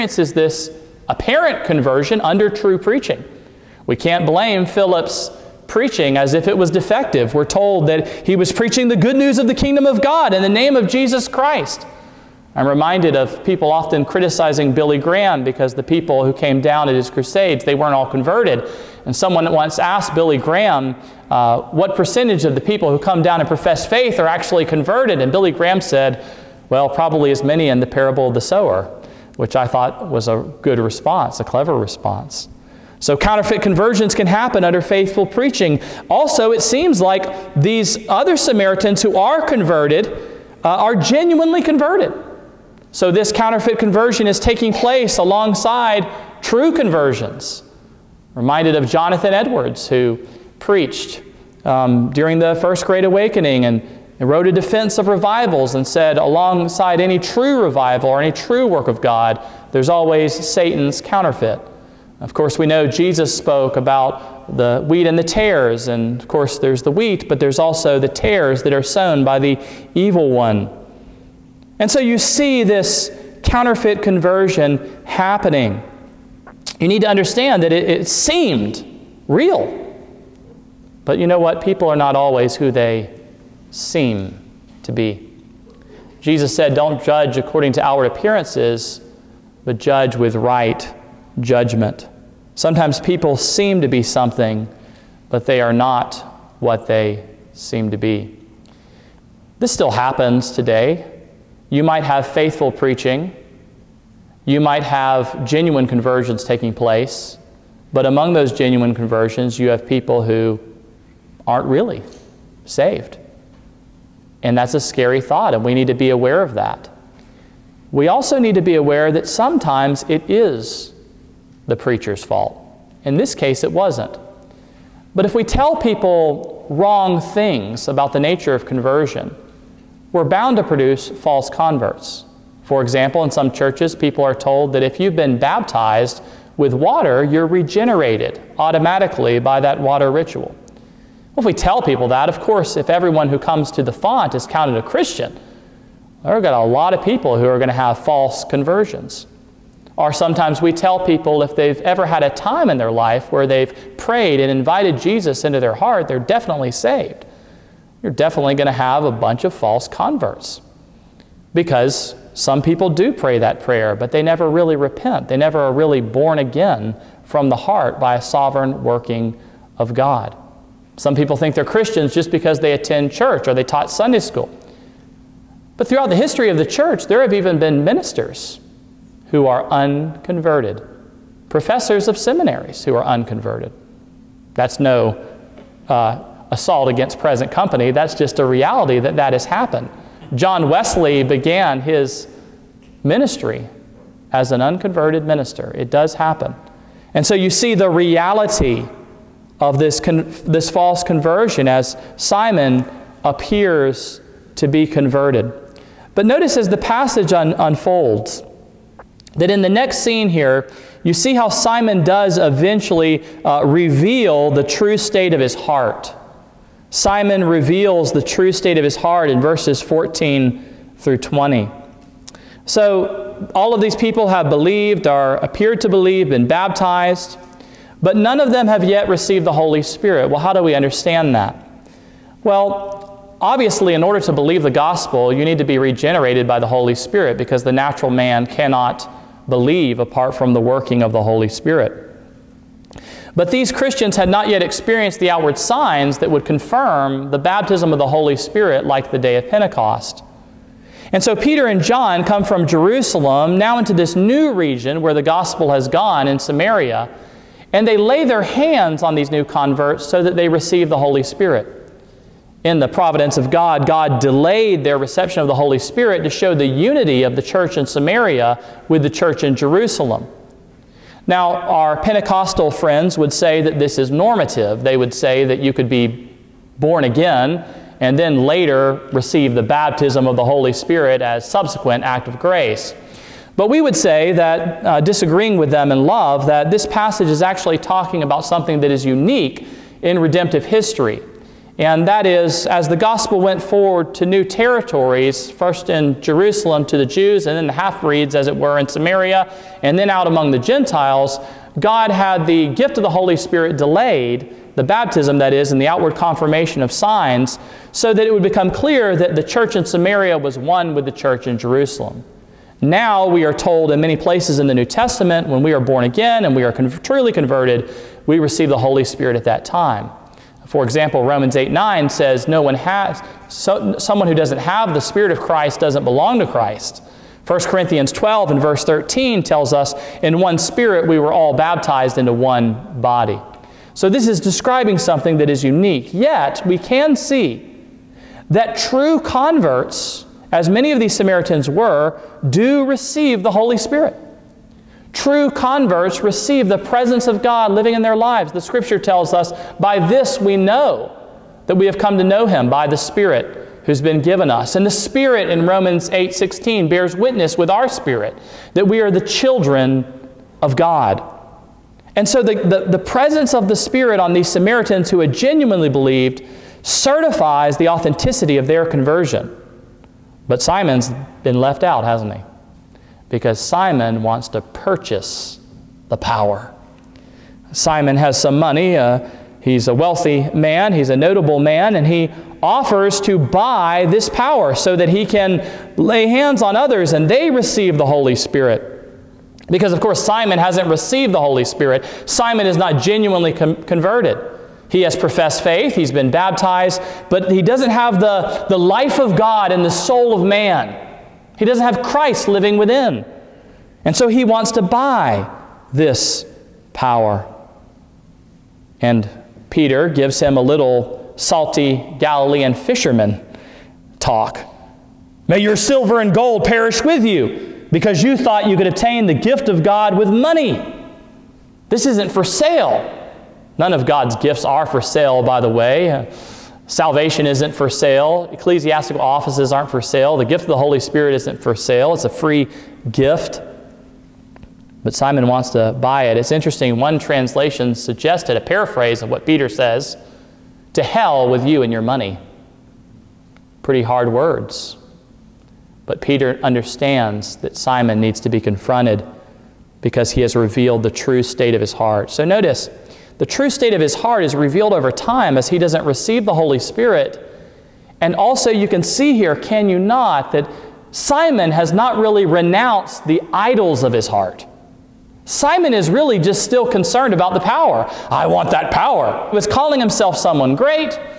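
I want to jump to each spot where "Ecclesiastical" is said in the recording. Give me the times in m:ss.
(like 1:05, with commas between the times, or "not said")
7:08.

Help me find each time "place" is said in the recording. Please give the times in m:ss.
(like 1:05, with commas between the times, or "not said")
0:44, 1:46, 5:14.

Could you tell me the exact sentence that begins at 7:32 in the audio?
So notice, the true state of his heart is revealed over time as he doesn't receive the Holy Spirit.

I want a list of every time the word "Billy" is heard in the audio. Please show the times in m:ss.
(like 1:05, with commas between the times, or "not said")
0:14, 0:20, 0:25.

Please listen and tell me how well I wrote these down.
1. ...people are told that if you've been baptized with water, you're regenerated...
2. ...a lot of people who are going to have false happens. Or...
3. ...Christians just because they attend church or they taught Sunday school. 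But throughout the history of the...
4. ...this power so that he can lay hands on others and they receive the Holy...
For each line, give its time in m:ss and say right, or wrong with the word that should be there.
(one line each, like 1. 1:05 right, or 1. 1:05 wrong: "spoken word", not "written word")
1. 2:13 right
2. 2:26 wrong: "conversions", not "happens"
3. 2:51 right
4. 6:24 right.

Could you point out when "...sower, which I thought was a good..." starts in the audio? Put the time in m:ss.
0:28.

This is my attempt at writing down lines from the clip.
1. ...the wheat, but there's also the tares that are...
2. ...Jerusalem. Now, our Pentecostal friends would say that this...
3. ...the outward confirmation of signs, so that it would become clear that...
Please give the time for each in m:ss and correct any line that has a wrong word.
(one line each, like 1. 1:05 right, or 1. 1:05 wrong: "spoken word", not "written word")
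1. 1:06 right
2. 4:29 right
3. 5:05 right.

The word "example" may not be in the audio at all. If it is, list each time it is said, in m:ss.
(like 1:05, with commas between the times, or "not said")
2:12, 5:20.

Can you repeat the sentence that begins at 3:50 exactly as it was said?
Well, how do we understand that?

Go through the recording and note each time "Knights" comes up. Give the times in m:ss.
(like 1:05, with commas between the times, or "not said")
not said.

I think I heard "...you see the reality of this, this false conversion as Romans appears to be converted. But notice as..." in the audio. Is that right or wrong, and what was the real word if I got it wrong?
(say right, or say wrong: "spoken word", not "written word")
wrong: "Simon", not "Romans".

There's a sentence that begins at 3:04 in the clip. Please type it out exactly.
That's no uh, assault against present company, that's just a reality that that has happened.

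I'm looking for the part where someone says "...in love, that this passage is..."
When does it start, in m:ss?
4:45.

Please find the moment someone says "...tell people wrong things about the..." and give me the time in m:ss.
2:05.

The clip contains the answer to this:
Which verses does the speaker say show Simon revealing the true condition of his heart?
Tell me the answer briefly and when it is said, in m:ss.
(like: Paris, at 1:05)
14 through 20, at 3:39.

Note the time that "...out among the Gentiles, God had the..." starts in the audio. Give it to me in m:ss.
5:00.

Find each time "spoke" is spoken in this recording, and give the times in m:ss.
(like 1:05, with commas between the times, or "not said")
1:03.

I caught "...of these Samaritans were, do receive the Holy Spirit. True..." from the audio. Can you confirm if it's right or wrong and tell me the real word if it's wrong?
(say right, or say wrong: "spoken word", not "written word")
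right.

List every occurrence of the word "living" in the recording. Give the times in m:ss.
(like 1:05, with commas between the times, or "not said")
5:47, 6:42.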